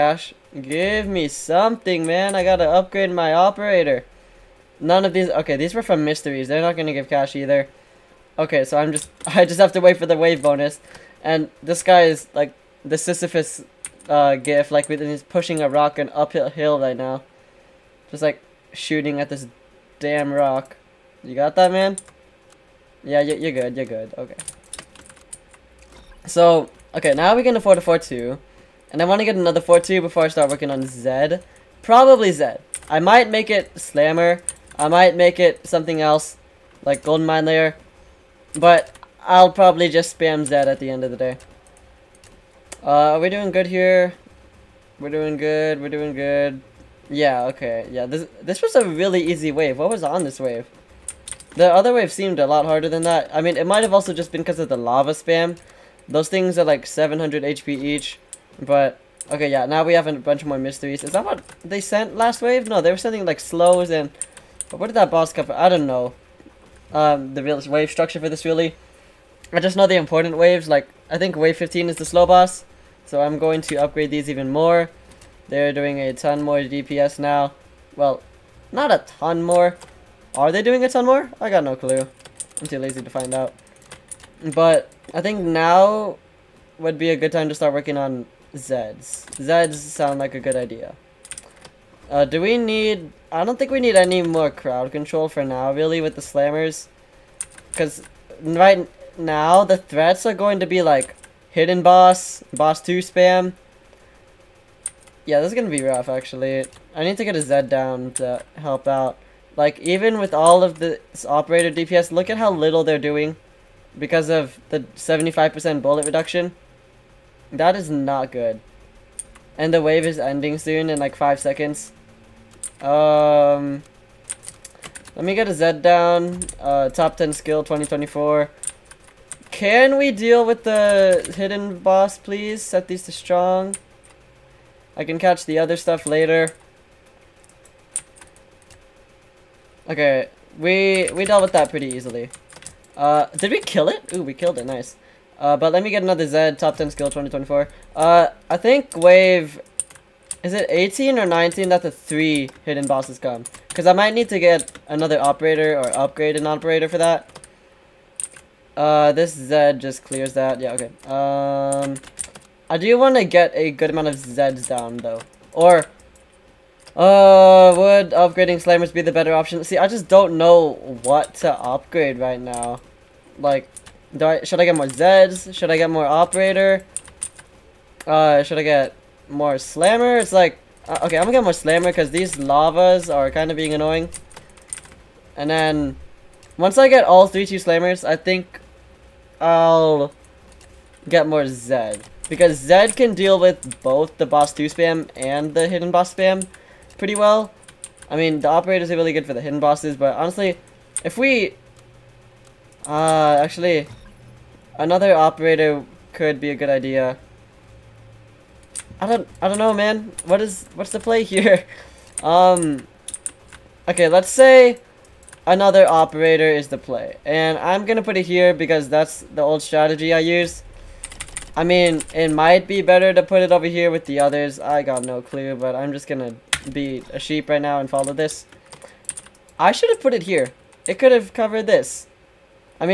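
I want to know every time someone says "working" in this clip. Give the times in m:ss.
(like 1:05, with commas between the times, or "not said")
0:30, 1:27.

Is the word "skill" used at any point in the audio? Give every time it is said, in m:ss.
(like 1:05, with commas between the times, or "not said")
2:07, 2:26.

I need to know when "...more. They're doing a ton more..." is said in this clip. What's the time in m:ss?
1:14.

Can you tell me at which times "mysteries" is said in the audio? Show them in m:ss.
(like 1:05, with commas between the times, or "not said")
0:06, 1:00.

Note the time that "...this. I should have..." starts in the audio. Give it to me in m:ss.
3:48.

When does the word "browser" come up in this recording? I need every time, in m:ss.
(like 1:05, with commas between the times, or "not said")
not said.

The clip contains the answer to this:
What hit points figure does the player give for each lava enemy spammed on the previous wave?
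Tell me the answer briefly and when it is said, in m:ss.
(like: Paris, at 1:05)
700, at 0:56.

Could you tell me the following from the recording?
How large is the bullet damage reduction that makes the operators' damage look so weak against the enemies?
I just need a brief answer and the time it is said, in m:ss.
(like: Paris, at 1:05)
75%, at 1:54.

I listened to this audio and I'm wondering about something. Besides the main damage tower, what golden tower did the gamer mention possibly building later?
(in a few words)
Golden Mine Layer.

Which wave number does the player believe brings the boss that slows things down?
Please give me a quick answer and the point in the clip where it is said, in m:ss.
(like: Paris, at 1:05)
15, at 1:11.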